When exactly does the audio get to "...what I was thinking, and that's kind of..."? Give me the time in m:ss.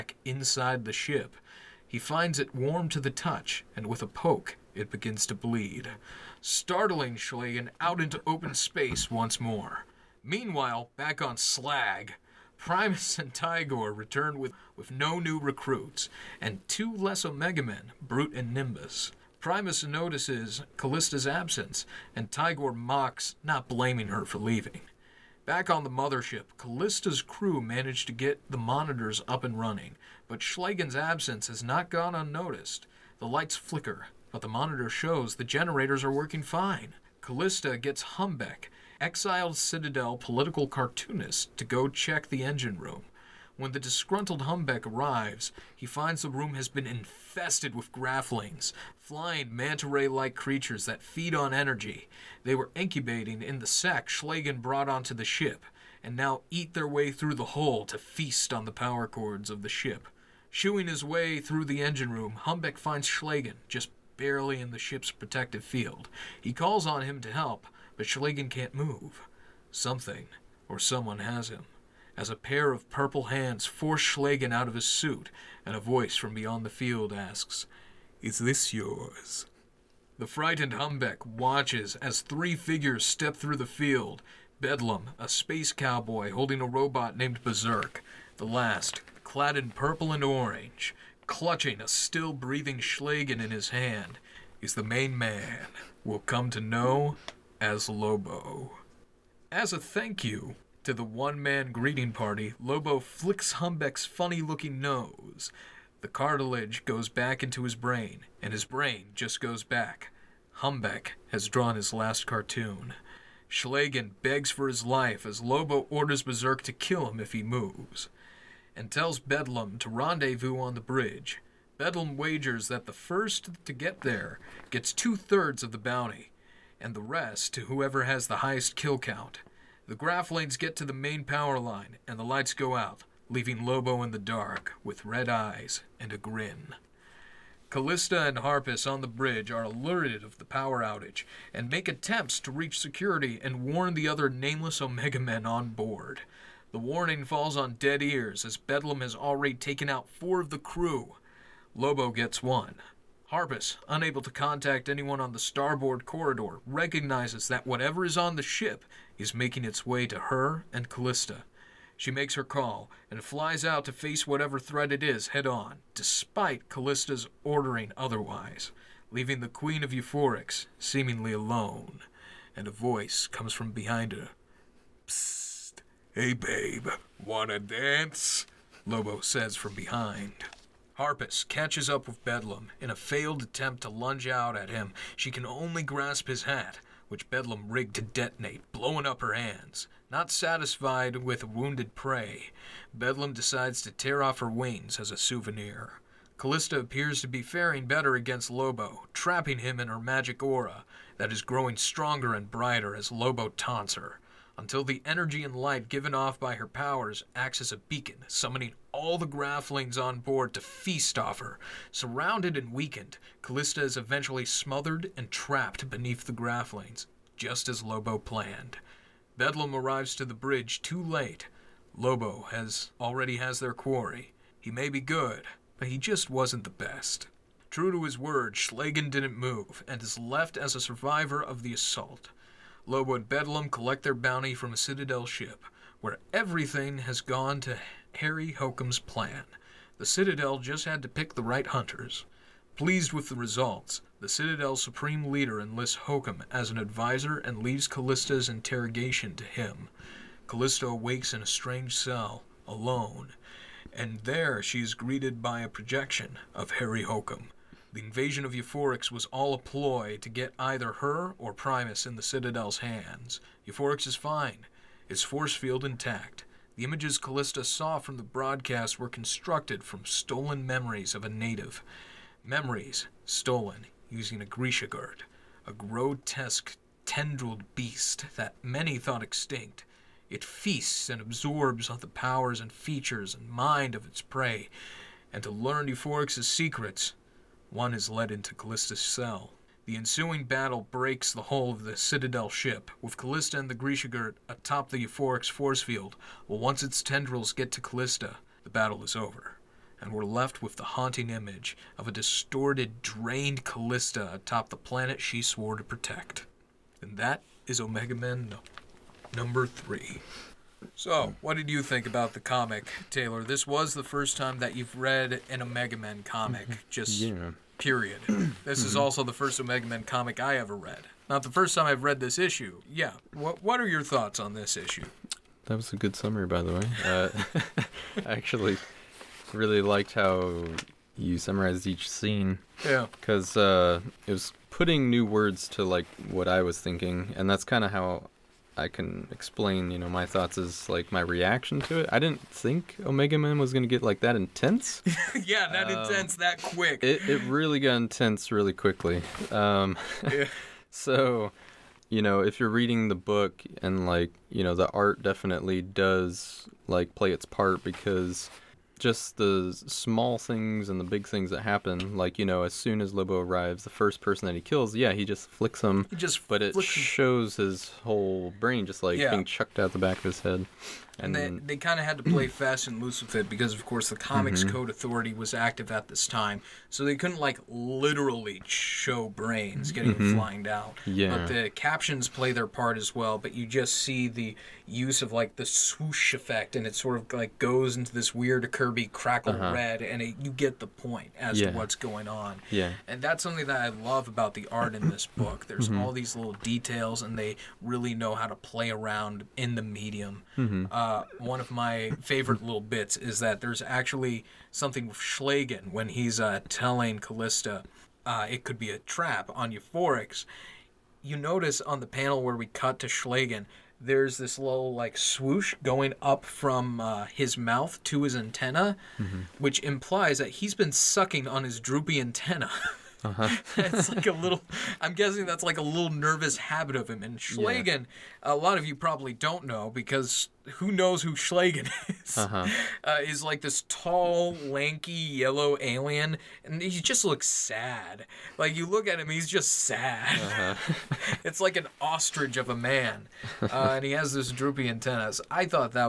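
5:36.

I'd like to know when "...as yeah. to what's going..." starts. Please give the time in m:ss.
6:31.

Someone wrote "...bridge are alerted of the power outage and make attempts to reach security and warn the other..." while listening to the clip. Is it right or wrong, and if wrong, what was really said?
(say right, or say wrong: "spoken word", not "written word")
right.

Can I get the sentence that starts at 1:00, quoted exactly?
Shooing his way through the engine room, Humbeck finds Schlagen just barely in the ship's protective field.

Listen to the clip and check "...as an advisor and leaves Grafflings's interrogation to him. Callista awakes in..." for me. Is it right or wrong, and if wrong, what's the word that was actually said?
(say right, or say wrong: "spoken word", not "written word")
wrong: "Callista", not "Grafflings".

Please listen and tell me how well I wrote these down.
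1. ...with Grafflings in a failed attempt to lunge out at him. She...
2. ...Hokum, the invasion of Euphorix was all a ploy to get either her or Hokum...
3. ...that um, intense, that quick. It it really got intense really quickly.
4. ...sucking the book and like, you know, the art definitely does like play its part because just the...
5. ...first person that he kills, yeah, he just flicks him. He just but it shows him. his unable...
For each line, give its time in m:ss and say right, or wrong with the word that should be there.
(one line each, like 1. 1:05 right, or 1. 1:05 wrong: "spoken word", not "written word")
1. 3:02 wrong: "Bedlam", not "Grafflings"
2. 4:17 wrong: "Primus", not "Hokum"
3. 5:45 right
4. 5:52 wrong: "reading", not "sucking"
5. 6:03 wrong: "whole", not "unable".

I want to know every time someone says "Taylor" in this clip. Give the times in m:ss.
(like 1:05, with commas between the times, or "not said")
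5:13.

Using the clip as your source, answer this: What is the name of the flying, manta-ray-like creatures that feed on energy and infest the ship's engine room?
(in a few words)
Grafflings.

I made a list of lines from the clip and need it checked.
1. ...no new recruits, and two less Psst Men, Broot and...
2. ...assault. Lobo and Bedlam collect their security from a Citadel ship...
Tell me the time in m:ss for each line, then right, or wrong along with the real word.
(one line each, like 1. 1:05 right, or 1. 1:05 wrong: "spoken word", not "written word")
1. 0:14 wrong: "Omega", not "Psst"
2. 3:51 wrong: "bounty", not "security".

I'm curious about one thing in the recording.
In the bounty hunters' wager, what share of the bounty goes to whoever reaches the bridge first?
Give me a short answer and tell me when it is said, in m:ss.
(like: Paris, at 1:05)
Two thirds, at 2:04.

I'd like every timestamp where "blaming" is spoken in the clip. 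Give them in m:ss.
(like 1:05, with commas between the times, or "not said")
0:23.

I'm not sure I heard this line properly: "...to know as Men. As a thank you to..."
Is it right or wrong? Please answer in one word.
wrong.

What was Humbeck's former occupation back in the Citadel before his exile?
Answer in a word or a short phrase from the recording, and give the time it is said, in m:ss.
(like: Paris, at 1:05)
Political cartoonist, at 0:40.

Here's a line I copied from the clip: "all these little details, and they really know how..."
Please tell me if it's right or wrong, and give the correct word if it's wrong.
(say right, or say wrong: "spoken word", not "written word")
right.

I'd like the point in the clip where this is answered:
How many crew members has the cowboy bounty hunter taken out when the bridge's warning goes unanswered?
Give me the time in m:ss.
2:30.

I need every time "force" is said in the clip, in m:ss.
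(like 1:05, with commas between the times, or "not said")
1:13, 4:25, 4:55.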